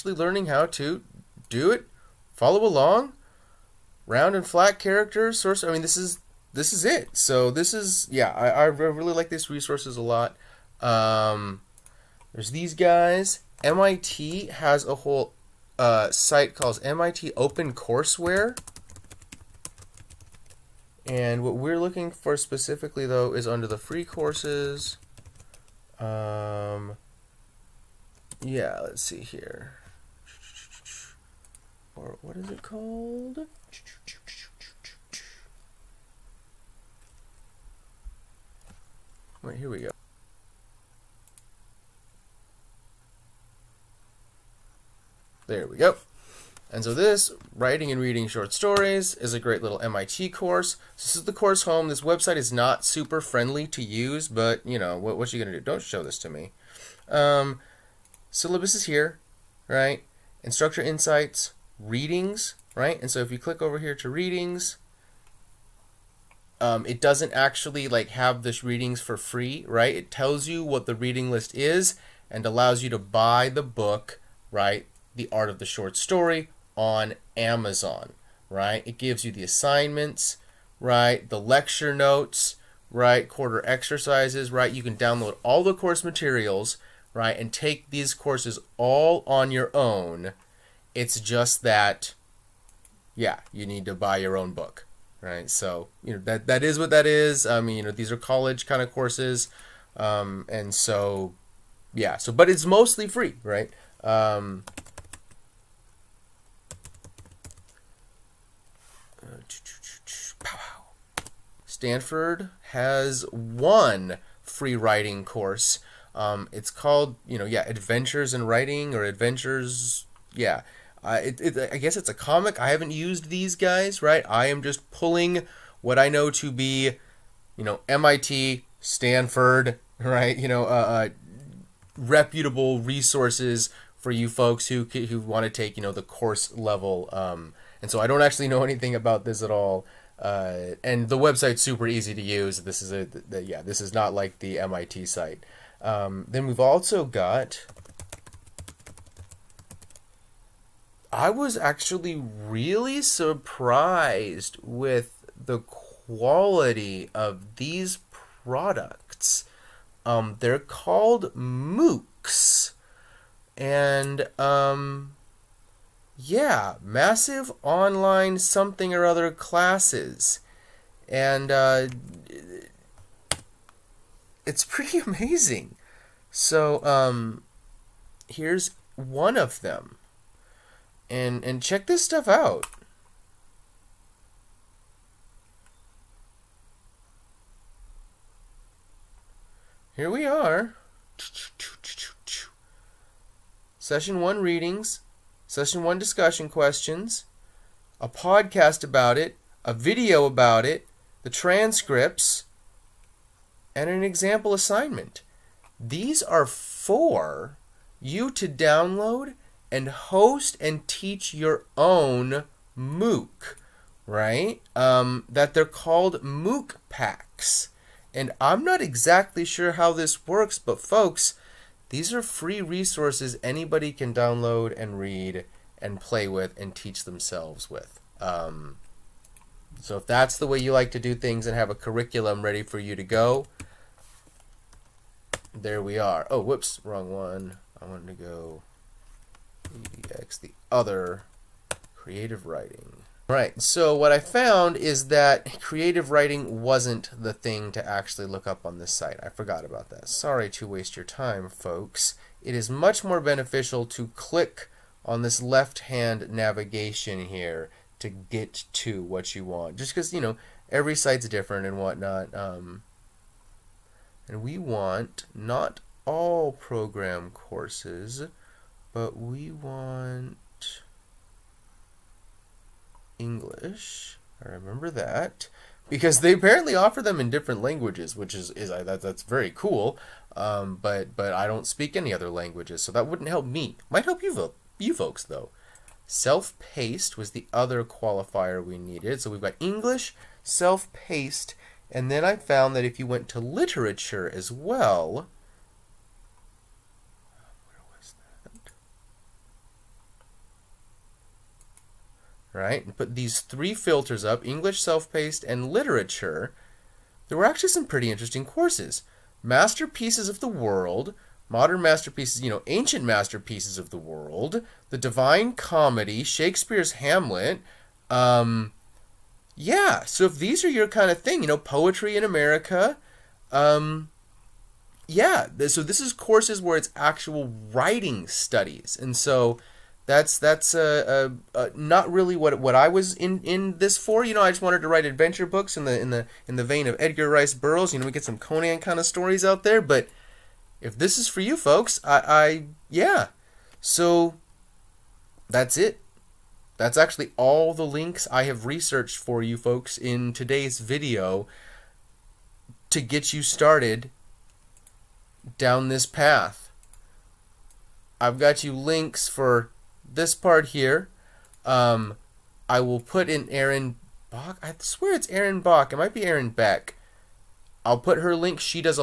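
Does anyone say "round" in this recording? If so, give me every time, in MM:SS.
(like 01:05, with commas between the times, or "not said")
00:04.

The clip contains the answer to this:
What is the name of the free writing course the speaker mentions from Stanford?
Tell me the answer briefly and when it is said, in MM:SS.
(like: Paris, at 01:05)
Adventures in Writing, at 01:57.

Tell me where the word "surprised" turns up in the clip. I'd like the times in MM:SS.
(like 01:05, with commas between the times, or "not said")
02:33.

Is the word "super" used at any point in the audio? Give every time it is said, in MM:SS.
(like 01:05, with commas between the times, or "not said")
00:52, 02:21.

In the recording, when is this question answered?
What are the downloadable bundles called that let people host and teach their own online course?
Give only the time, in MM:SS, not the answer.
03:36.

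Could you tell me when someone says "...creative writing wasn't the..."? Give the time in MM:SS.
04:05.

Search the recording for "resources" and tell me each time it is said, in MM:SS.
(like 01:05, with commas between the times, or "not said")
00:09, 02:12, 03:42.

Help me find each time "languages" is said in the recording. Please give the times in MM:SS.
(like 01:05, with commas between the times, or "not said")
04:37, 04:42.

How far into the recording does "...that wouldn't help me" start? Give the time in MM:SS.
04:42.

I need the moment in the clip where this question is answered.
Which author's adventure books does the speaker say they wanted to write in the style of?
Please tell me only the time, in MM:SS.
05:36.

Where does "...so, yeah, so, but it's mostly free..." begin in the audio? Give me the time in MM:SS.
01:40.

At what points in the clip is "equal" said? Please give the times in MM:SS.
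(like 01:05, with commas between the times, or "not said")
not said.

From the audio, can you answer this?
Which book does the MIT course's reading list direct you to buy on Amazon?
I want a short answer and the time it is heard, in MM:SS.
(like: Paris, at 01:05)
The Art of the Short Story, at 01:15.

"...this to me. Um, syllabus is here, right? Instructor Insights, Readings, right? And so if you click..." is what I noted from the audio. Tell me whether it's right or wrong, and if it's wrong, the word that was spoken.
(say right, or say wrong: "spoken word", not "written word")
right.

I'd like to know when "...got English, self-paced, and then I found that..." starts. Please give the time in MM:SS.
04:49.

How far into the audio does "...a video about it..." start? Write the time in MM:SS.
03:19.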